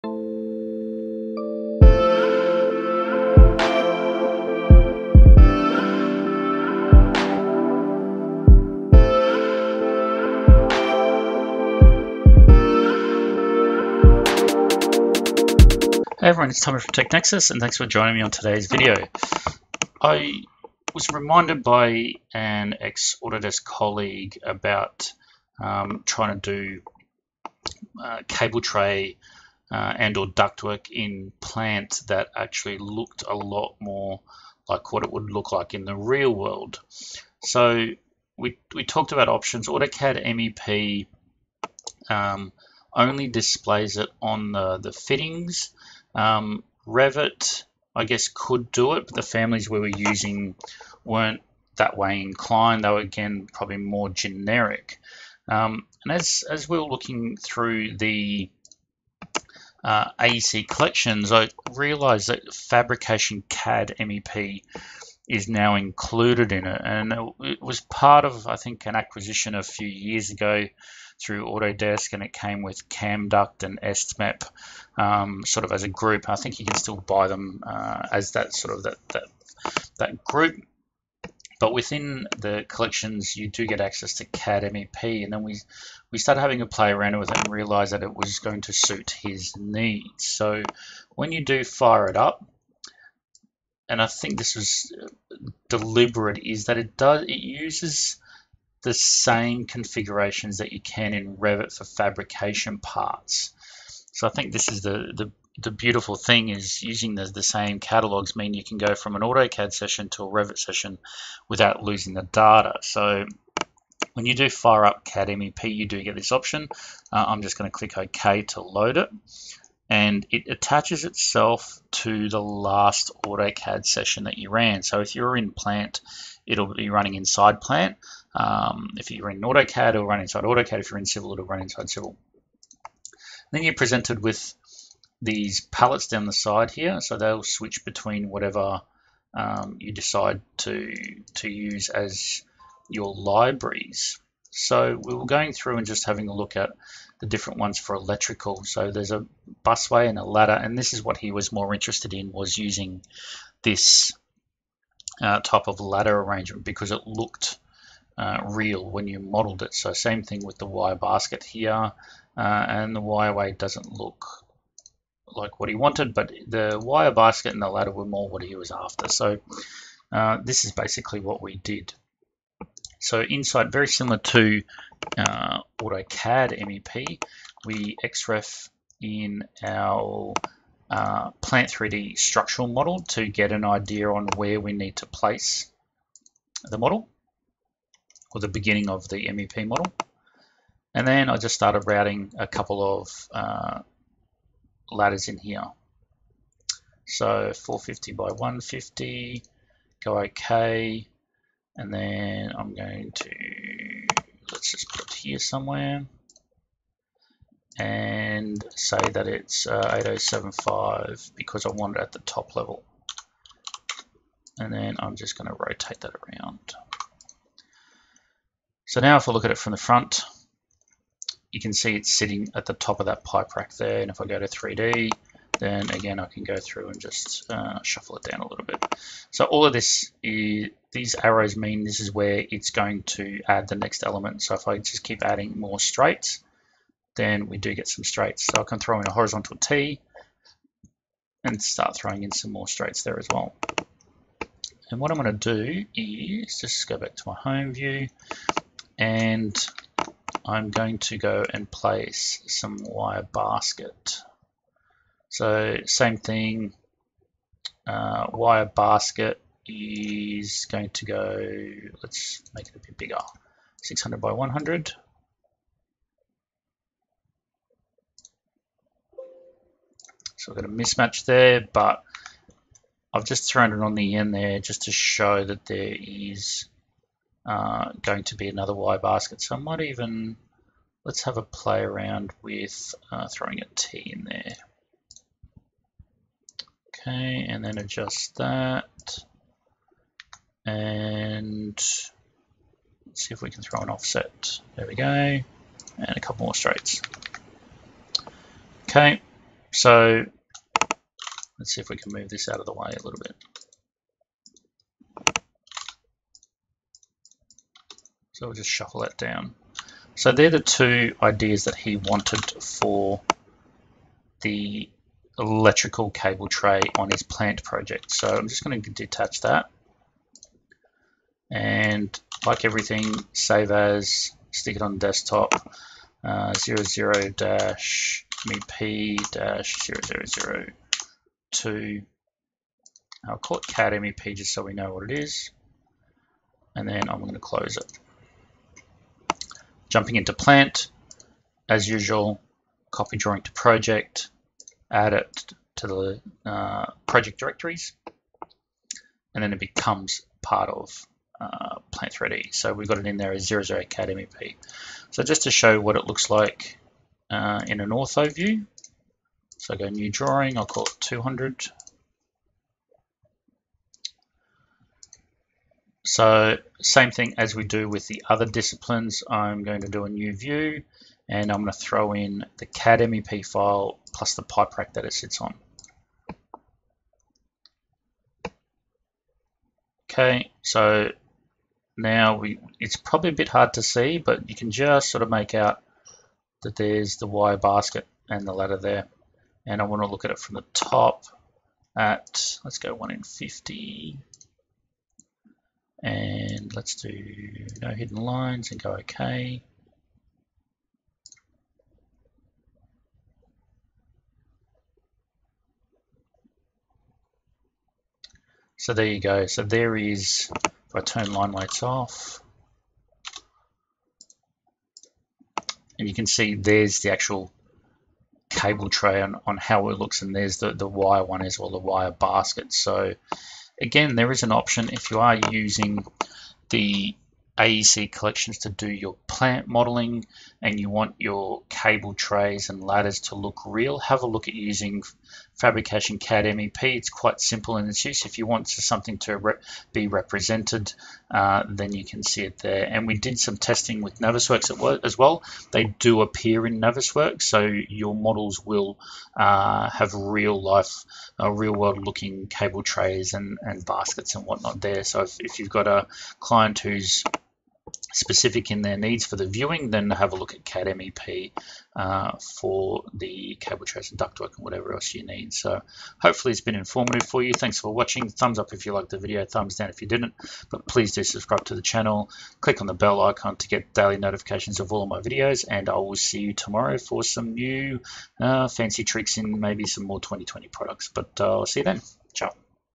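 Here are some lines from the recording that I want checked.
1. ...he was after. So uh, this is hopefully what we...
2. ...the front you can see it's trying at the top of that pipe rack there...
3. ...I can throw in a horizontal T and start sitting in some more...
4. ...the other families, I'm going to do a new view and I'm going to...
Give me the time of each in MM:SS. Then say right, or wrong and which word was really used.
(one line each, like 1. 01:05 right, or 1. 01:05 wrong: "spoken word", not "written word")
1. 02:48 wrong: "basically", not "hopefully"
2. 03:39 wrong: "sitting", not "trying"
3. 03:58 wrong: "throwing", not "sitting"
4. 06:08 wrong: "disciplines", not "families".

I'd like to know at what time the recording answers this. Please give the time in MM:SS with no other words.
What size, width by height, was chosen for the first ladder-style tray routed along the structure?
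03:17.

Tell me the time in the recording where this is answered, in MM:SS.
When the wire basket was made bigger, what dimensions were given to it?
04:23.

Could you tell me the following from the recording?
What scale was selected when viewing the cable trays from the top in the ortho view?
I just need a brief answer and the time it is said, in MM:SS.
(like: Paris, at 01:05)
1 in 50, at 06:32.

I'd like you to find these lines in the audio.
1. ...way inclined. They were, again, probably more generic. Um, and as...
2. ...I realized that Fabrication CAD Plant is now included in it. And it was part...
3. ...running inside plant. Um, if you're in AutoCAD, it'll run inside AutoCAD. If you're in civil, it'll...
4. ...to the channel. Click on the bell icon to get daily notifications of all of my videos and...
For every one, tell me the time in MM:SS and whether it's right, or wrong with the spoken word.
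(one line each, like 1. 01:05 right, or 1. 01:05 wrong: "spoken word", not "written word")
1. 00:51 right
2. 01:01 wrong: "MEP", not "Plant"
3. 02:06 right
4. 07:51 right.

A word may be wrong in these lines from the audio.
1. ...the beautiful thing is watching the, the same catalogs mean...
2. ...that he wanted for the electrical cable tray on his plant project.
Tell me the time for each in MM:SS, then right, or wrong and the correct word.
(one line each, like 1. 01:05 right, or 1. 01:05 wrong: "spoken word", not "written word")
1. 01:45 wrong: "using", not "watching"
2. 05:11 right.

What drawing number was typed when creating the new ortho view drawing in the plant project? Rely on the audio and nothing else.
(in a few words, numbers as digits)
200.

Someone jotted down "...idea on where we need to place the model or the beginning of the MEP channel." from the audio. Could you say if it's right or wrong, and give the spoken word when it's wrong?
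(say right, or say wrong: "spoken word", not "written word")
wrong: "model", not "channel".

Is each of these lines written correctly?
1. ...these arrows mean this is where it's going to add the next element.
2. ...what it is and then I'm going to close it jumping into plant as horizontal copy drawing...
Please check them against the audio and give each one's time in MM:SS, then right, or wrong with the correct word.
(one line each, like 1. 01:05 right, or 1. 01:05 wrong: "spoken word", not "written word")
1. 03:50 right
2. 05:34 wrong: "usual", not "horizontal".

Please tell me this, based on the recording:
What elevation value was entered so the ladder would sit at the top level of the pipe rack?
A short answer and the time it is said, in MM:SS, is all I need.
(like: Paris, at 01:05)
8075, at 03:29.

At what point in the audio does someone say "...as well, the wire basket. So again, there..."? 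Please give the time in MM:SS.
07:01.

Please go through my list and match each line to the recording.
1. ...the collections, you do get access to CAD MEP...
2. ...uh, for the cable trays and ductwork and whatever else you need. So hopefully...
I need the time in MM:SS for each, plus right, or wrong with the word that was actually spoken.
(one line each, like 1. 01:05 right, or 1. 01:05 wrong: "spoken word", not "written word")
1. 01:22 right
2. 07:41 right.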